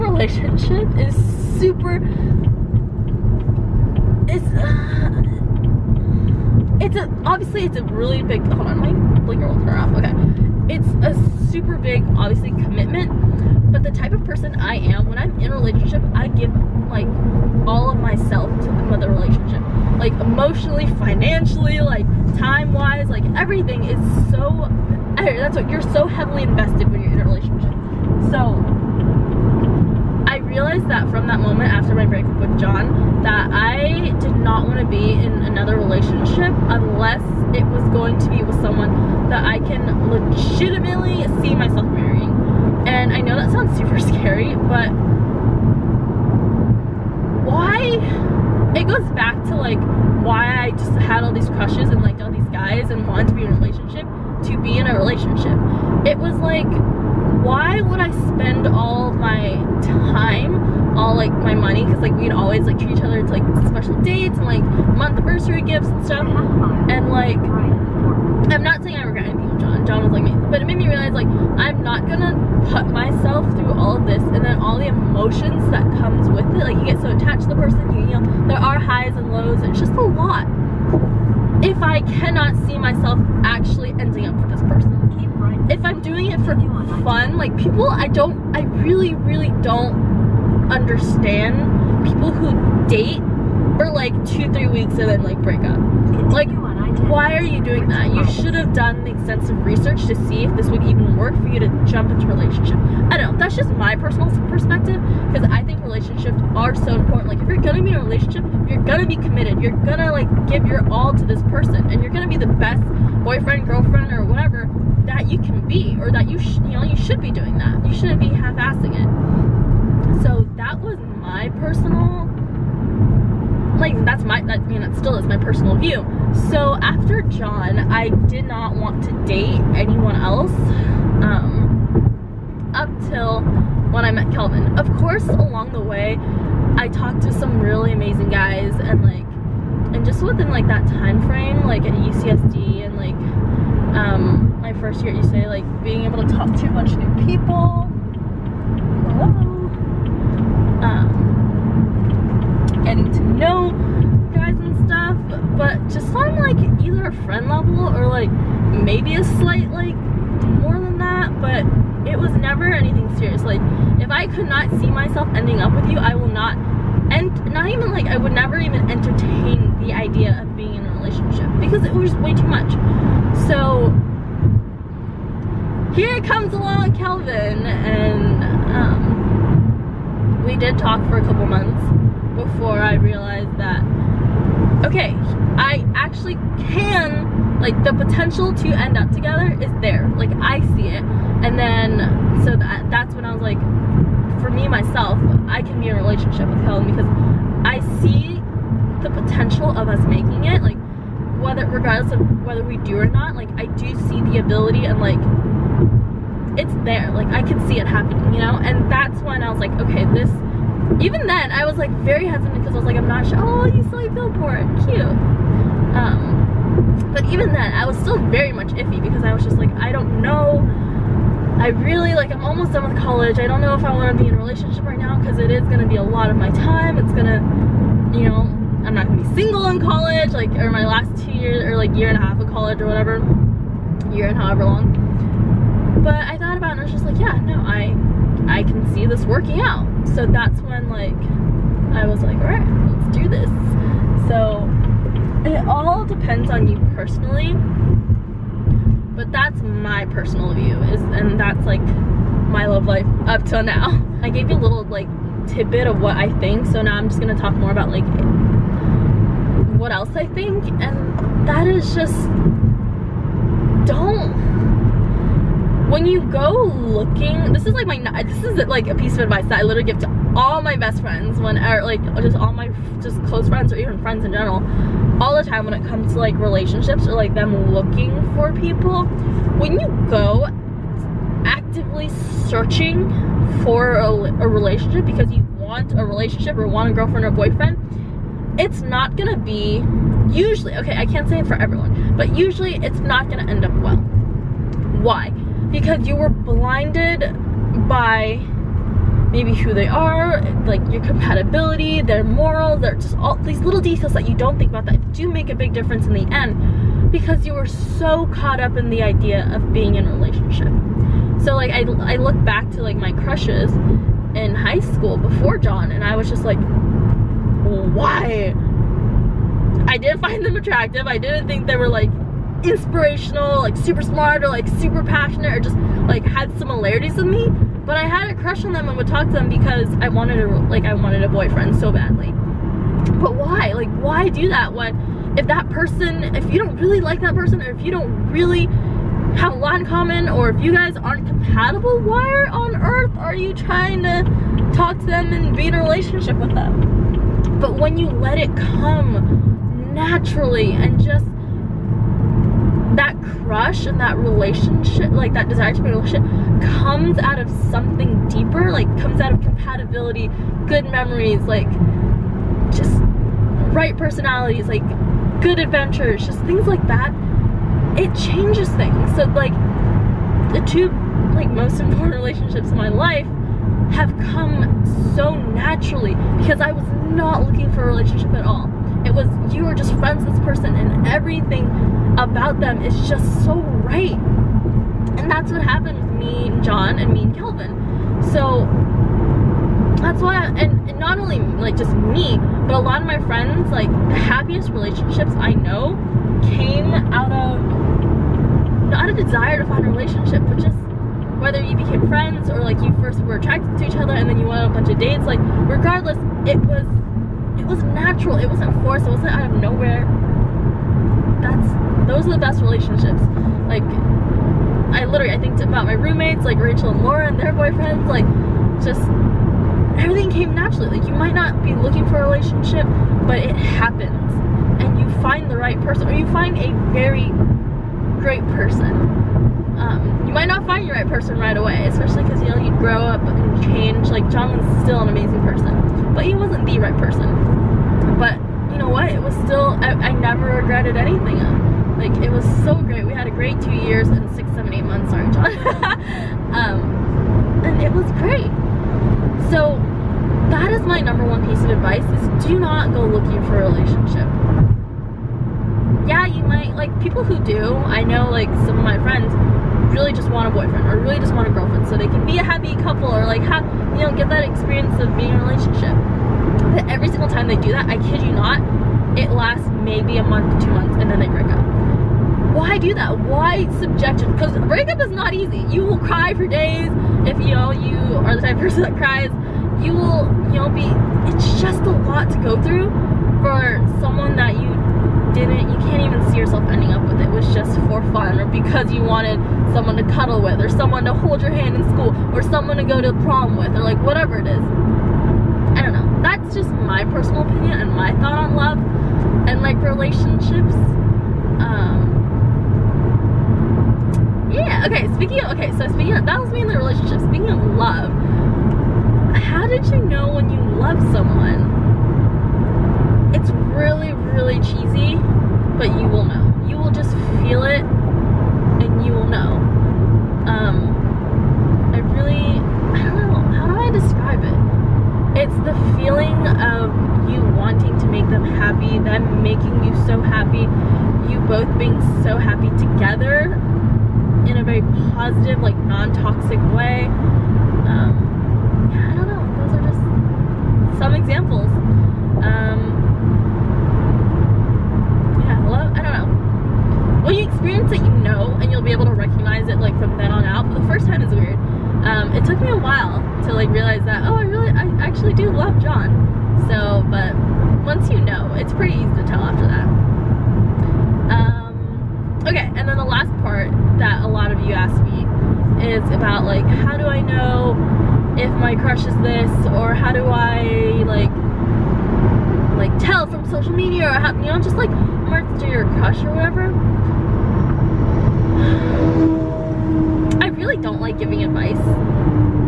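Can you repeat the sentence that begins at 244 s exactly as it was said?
So it all depends on you personally, but that's my personal view is, and that's like my love life up till now.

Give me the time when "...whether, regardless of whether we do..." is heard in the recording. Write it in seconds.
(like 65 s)
201 s.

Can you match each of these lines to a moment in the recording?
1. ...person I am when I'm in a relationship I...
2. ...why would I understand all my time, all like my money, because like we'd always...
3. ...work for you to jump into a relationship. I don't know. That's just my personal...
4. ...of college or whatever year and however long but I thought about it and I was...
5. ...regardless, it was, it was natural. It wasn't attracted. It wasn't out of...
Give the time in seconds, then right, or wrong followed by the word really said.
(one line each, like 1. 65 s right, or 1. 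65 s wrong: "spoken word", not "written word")
1. 14 s right
2. 57 s wrong: "spend", not "understand"
3. 101 s right
4. 232 s right
5. 405 s wrong: "forced", not "attracted".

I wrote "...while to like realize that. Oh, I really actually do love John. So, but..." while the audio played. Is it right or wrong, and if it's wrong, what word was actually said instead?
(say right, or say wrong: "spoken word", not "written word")
right.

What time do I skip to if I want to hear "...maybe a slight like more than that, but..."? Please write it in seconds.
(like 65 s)
158 s.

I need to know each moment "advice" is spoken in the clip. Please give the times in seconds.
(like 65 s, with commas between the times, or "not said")
269 s, 451 s, 581 s.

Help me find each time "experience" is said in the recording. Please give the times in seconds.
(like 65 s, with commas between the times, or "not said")
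464 s, 547 s.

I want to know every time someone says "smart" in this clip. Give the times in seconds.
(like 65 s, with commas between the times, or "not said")
324 s.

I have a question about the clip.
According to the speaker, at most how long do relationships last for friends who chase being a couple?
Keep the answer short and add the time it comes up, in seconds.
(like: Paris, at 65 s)
2 months, at 470 s.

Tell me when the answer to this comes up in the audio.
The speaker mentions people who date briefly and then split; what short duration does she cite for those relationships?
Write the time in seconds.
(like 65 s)
94 s.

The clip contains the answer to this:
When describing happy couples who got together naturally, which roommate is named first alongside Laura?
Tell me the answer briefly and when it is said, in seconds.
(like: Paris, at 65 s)
Rachel, at 416 s.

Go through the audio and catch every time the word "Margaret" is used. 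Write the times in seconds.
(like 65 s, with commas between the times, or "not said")
not said.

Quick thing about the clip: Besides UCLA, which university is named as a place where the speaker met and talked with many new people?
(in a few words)
UCSD.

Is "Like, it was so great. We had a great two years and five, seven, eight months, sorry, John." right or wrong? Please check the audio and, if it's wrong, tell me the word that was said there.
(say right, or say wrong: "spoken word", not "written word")
wrong: "six", not "five".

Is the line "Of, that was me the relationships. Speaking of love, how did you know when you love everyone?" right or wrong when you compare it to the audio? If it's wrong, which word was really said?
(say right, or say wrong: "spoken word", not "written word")
wrong: "someone", not "everyone".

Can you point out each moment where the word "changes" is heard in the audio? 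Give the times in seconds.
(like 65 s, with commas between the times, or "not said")
368 s, 433 s.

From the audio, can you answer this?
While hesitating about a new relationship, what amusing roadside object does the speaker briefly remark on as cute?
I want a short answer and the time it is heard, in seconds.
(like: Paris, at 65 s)
billboard, at 214 s.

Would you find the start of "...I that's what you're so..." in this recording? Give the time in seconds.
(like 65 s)
25 s.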